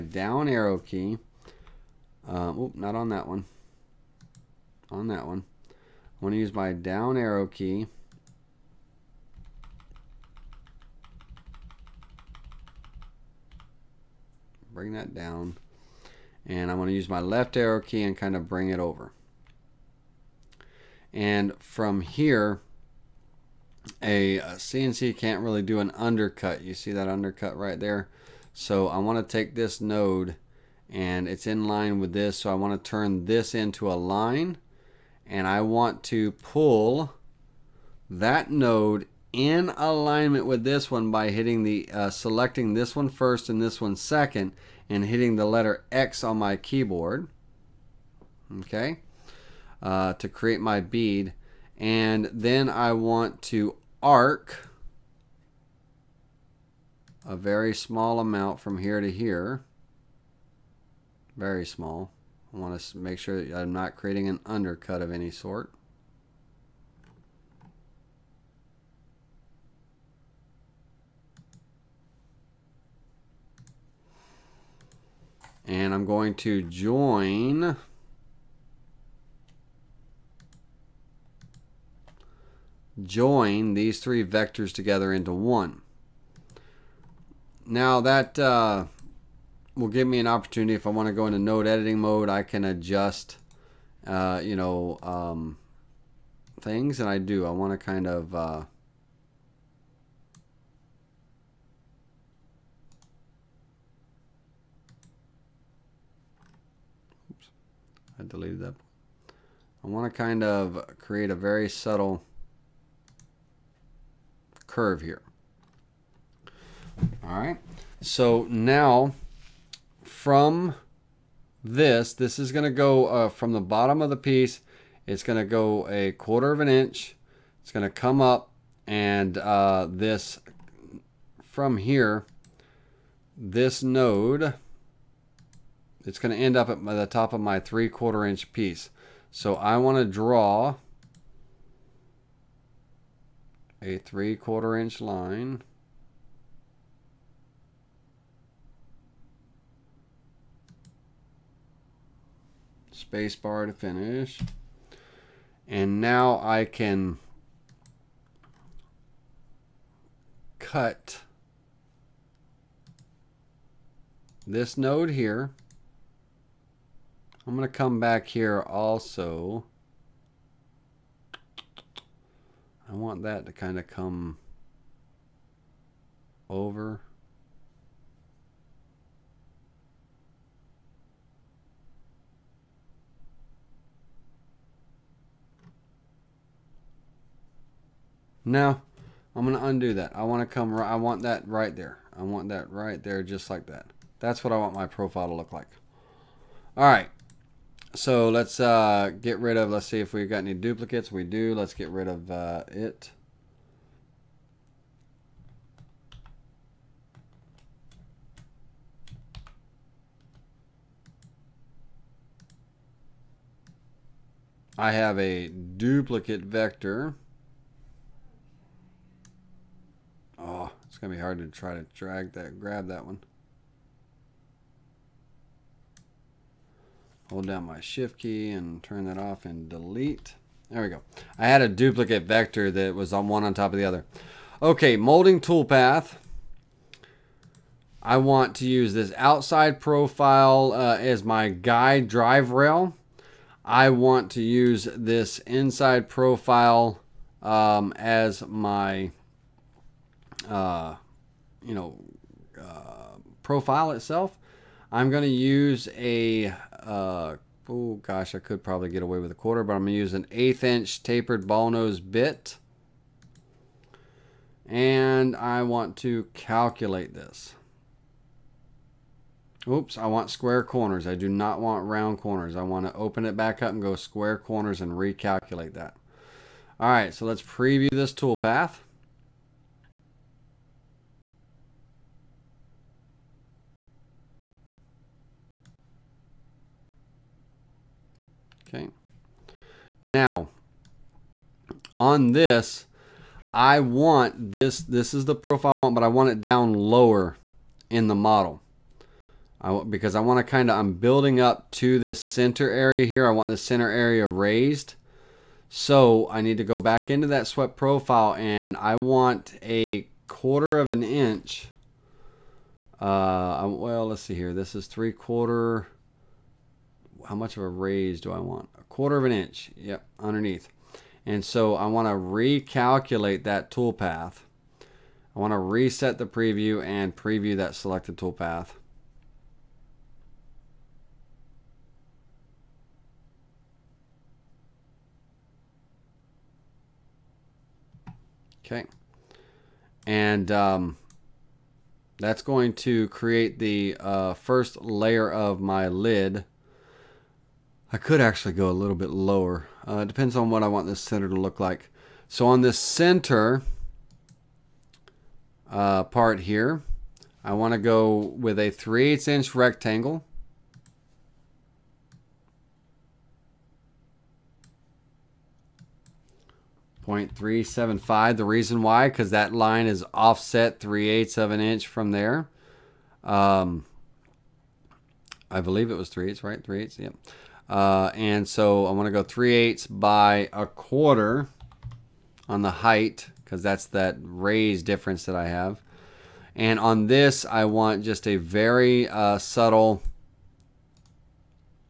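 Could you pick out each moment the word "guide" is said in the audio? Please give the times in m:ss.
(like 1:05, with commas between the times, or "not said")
4:01.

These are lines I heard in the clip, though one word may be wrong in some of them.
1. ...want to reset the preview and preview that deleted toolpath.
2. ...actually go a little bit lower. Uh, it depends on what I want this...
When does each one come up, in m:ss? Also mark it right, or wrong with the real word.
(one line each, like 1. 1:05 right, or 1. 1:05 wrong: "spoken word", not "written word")
1. 5:25 wrong: "selected", not "deleted"
2. 5:48 right.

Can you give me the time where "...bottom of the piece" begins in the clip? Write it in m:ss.
2:03.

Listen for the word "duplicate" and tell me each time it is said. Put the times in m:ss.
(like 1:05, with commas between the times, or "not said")
3:20, 3:35, 3:51.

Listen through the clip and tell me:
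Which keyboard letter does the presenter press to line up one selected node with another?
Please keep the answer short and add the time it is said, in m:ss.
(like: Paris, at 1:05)
X, at 0:45.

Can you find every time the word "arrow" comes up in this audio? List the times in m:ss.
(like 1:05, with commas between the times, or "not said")
0:00, 0:07, 0:17.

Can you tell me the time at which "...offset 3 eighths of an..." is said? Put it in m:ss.
6:10.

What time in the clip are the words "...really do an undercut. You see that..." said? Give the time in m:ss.
0:25.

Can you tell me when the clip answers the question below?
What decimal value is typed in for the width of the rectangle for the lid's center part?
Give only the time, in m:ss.
6:07.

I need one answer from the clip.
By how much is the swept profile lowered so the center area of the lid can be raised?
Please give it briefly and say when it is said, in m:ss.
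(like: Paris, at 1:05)
1/4 inch, at 5:18.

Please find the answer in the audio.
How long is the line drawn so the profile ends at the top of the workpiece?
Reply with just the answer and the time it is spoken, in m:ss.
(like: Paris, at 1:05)
3/4 inch, at 2:23.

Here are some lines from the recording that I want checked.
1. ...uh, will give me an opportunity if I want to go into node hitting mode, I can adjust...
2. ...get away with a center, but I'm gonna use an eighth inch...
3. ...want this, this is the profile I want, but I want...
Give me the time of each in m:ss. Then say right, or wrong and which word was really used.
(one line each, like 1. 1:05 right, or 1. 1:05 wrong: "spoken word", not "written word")
1. 1:28 wrong: "editing", not "hitting"
2. 4:18 wrong: "quarter", not "center"
3. 4:53 right.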